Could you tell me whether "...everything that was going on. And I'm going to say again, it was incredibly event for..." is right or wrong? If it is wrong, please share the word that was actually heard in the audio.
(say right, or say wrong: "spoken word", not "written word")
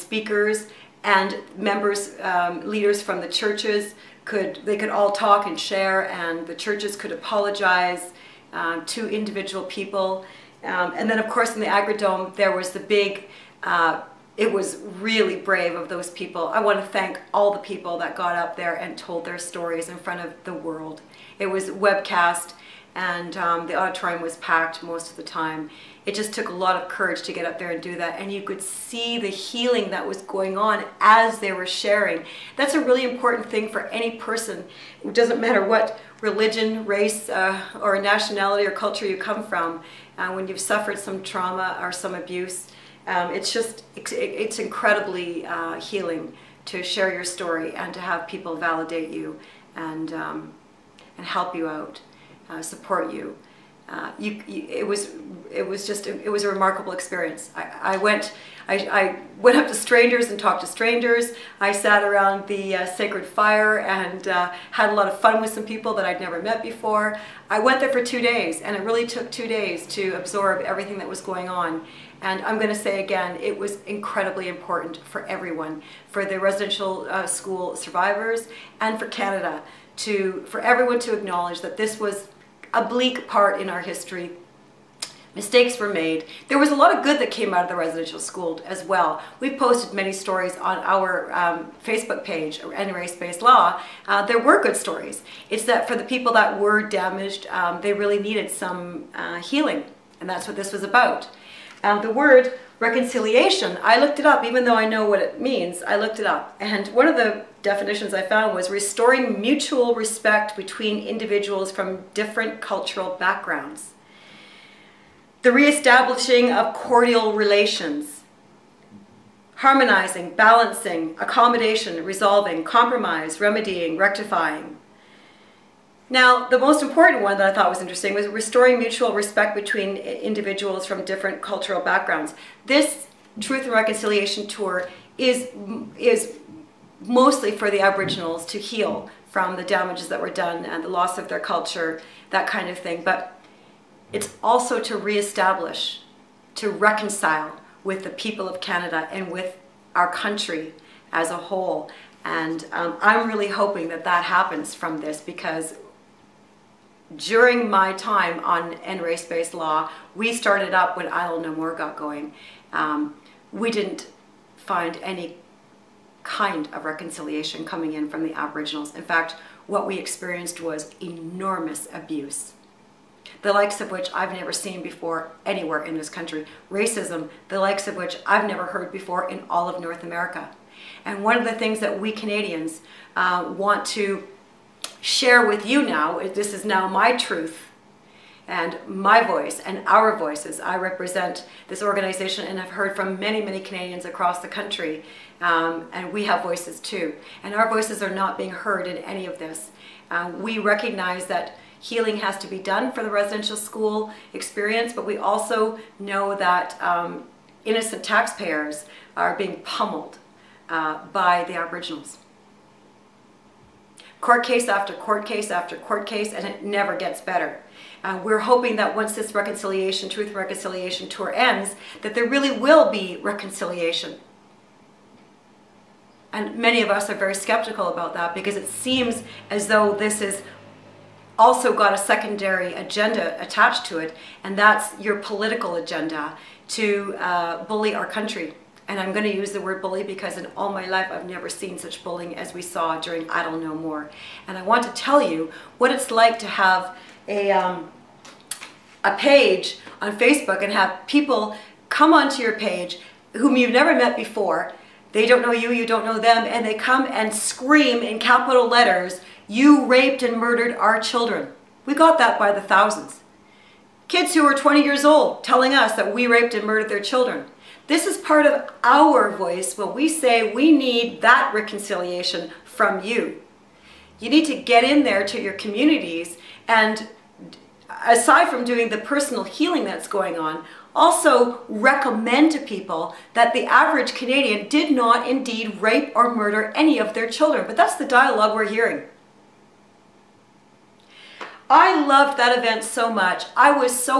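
wrong: "important", not "event".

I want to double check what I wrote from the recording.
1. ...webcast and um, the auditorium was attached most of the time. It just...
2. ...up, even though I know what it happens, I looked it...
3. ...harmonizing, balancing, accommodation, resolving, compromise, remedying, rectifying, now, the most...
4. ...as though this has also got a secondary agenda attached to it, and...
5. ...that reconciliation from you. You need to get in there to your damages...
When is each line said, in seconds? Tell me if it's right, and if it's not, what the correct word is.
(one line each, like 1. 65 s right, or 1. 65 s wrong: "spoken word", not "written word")
1. 21 s wrong: "packed", not "attached"
2. 104 s wrong: "means", not "happens"
3. 119 s right
4. 229 s right
5. 271 s wrong: "communities", not "damages".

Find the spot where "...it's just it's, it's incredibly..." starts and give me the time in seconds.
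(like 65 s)
43 s.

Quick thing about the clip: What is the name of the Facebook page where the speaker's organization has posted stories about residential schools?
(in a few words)
NRA Race-Based Law.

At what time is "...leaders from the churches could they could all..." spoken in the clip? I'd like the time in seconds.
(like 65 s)
2 s.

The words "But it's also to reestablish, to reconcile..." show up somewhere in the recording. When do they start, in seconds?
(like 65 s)
143 s.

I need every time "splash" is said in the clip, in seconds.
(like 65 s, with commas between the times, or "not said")
not said.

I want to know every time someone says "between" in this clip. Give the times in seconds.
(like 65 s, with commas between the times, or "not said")
110 s, 129 s.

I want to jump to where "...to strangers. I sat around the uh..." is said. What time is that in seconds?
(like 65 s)
60 s.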